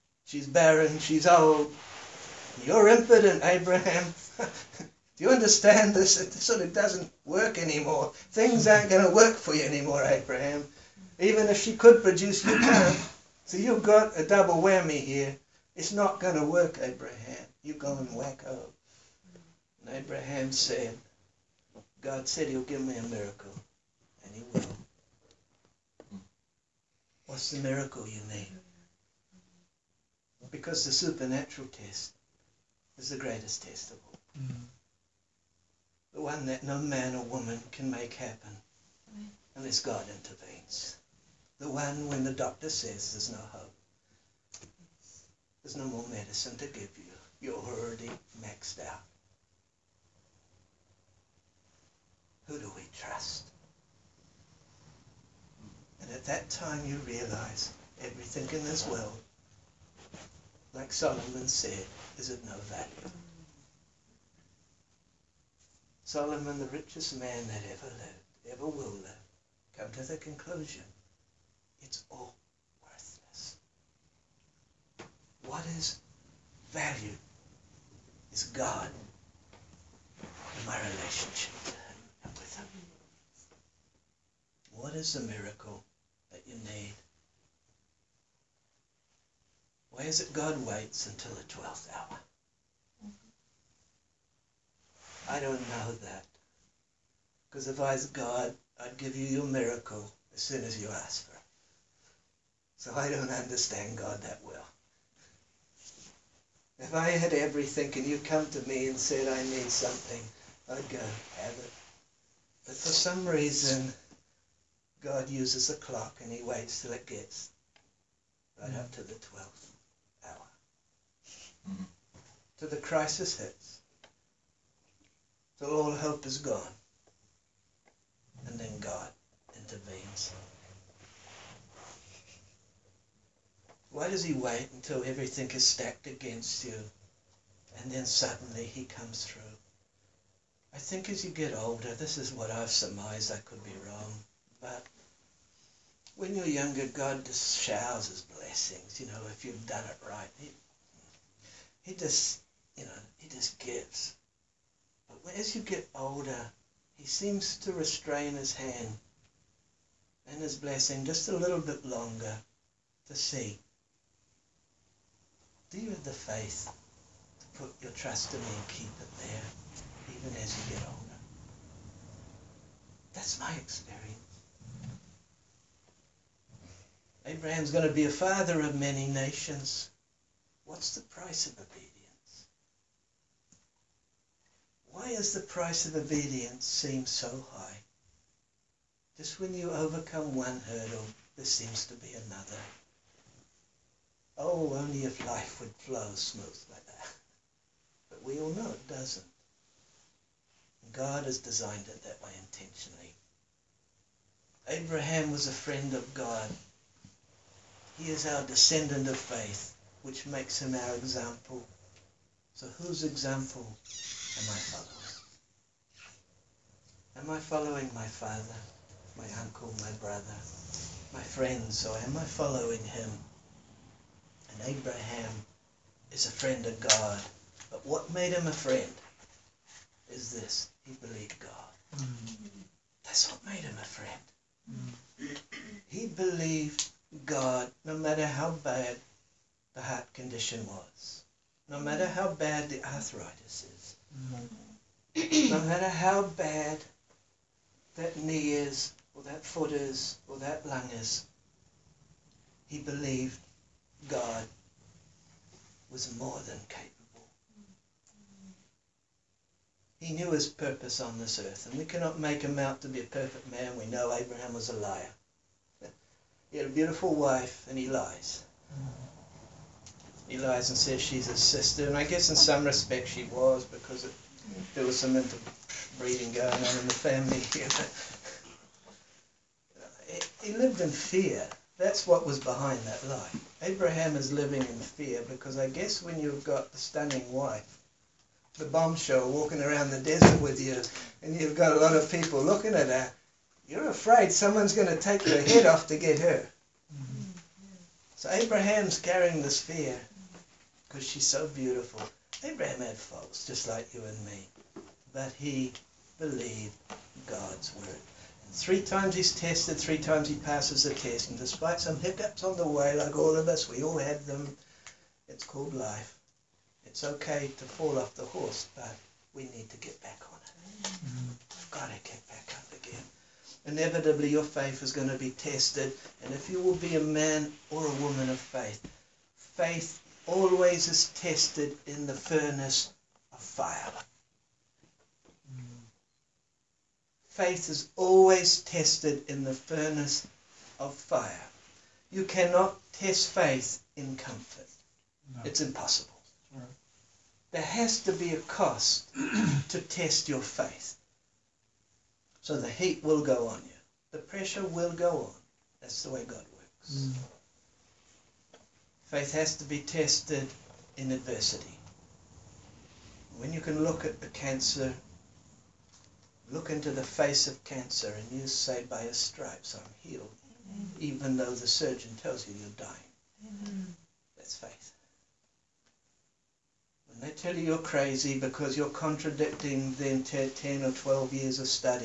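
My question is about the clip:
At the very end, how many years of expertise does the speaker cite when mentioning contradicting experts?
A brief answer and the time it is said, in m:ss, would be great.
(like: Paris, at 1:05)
10 or 12 years, at 6:20.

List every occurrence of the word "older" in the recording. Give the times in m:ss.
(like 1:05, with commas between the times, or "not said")
2:21, 2:35, 2:50.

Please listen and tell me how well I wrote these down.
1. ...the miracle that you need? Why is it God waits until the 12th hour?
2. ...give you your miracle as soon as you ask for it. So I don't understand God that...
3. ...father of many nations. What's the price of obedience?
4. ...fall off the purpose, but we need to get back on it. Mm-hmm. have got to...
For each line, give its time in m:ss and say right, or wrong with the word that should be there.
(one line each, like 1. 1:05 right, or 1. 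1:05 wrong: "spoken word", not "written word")
1. 1:25 right
2. 1:38 right
3. 2:58 right
4. 5:17 wrong: "horse", not "purpose".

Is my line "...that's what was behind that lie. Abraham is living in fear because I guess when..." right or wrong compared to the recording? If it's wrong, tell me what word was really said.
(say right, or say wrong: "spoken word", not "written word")
right.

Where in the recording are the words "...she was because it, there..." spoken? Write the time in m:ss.
4:33.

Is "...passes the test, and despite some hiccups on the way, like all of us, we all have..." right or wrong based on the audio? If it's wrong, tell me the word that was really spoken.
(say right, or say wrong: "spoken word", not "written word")
right.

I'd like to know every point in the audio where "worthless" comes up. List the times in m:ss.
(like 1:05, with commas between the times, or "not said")
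1:12.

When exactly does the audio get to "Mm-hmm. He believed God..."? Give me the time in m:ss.
3:54.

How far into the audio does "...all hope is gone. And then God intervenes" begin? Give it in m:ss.
2:05.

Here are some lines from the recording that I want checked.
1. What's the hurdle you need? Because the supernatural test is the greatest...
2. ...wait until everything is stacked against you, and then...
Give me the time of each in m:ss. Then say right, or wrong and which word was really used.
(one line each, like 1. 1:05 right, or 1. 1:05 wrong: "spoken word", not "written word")
1. 0:27 wrong: "miracle", not "hurdle"
2. 2:14 right.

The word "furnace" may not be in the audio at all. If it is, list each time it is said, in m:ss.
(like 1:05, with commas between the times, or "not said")
5:32, 5:39.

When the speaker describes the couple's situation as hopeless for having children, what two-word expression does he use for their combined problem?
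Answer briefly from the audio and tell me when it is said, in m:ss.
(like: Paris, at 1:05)
double whammy, at 0:14.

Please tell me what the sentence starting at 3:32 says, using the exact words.
So whose example am I following?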